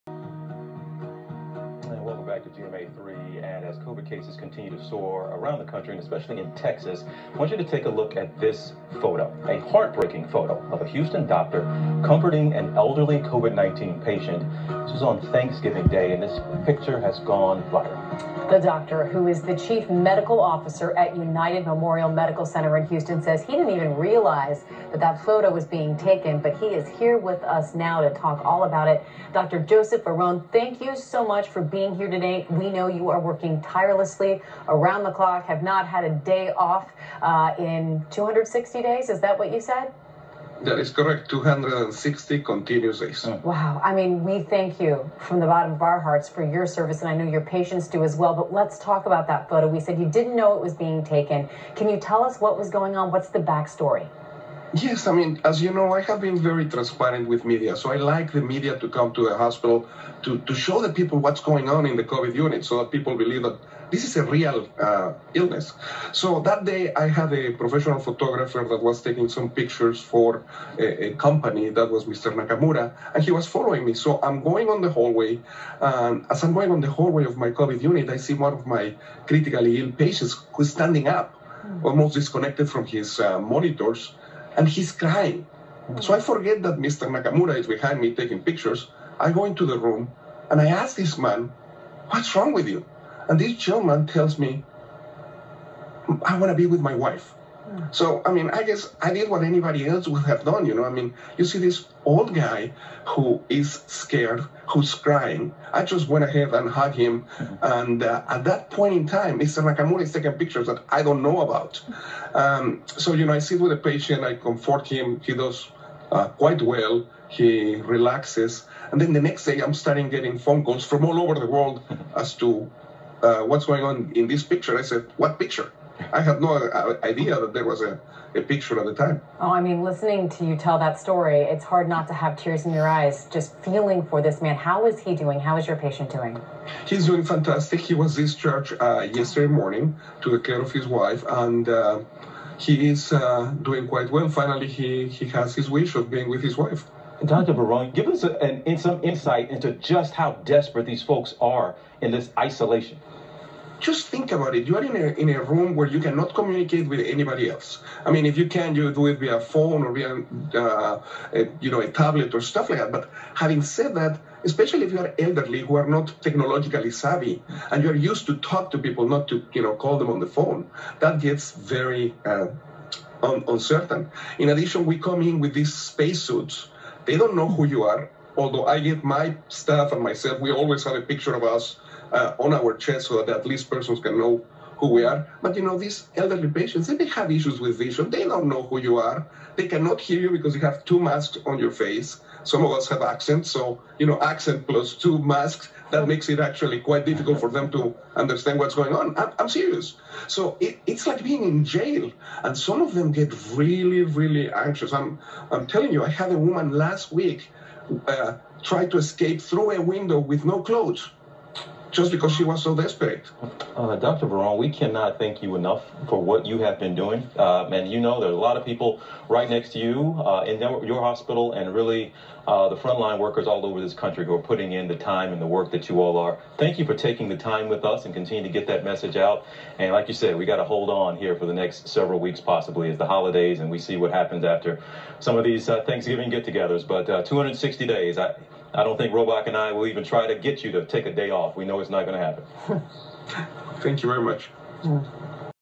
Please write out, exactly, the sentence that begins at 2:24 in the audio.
Finally, he, he has his wish of being with his wife.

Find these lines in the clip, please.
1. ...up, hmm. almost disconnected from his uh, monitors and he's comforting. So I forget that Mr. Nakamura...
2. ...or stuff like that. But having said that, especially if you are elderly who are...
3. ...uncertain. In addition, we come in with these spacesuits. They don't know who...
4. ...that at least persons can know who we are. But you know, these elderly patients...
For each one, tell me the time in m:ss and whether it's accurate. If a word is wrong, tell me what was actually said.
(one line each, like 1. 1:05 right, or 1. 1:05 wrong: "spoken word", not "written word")
1. 1:21 wrong: "crying", not "comforting"
2. 2:42 right
3. 2:53 right
4. 3:03 right.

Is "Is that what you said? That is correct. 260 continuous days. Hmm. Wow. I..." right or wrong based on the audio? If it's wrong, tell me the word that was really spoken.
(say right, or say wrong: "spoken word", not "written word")
right.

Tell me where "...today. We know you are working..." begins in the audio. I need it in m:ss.
0:32.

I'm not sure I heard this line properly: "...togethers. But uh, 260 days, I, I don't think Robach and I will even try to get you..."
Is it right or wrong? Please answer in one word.
right.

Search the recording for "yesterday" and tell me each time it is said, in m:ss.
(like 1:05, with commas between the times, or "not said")
2:19.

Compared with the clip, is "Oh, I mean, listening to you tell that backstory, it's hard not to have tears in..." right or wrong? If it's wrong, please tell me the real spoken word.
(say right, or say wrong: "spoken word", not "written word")
wrong: "story", not "backstory".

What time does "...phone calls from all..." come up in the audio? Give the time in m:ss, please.
2:00.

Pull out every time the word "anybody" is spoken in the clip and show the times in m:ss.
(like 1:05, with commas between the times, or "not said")
1:39, 2:36.